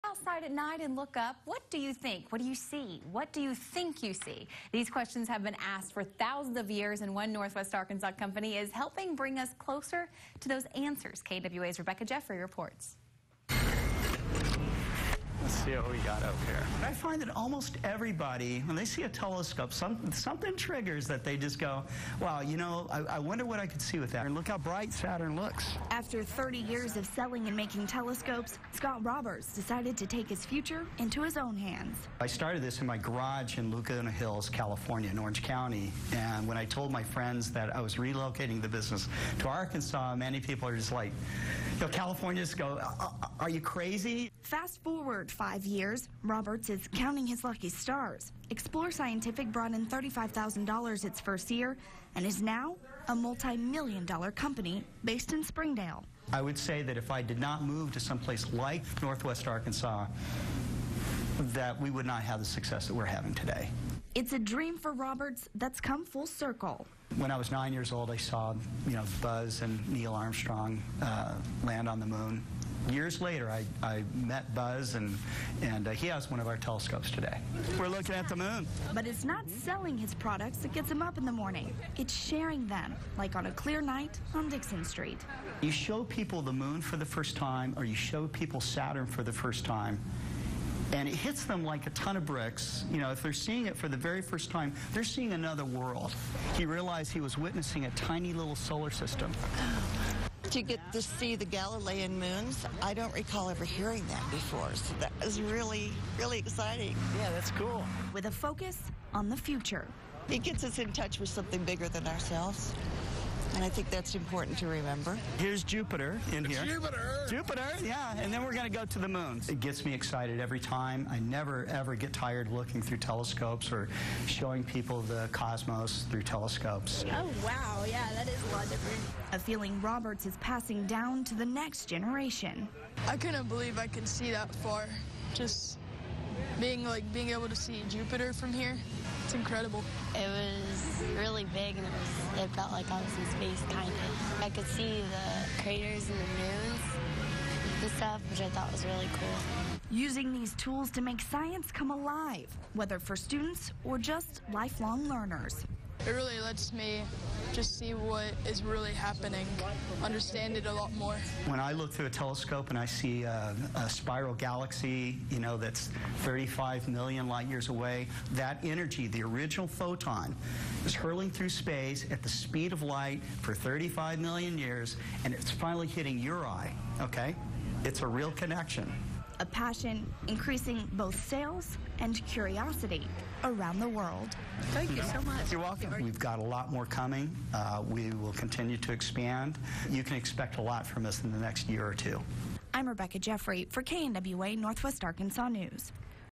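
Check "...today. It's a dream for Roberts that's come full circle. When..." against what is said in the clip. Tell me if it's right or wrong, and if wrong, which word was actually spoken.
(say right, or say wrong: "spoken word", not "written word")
right.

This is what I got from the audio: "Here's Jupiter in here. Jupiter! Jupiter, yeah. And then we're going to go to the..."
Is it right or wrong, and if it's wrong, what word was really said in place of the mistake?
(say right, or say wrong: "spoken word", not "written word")
right.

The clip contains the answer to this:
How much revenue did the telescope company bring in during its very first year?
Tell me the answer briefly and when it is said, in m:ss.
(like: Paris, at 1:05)
$35,000, at 0:49.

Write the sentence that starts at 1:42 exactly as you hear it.
I don't recall ever hearing that before, so that was really, really exciting.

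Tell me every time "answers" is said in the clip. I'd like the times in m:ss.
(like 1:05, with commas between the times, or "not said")
0:10.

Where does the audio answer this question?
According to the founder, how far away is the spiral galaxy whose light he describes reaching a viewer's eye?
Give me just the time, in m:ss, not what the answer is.
2:46.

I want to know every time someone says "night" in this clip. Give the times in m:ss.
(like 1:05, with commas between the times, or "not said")
0:00, 1:23.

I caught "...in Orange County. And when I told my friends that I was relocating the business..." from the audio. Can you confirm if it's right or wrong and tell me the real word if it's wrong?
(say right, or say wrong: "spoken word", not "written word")
right.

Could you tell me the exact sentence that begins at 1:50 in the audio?
It gets us in touch with something bigger than ourselves.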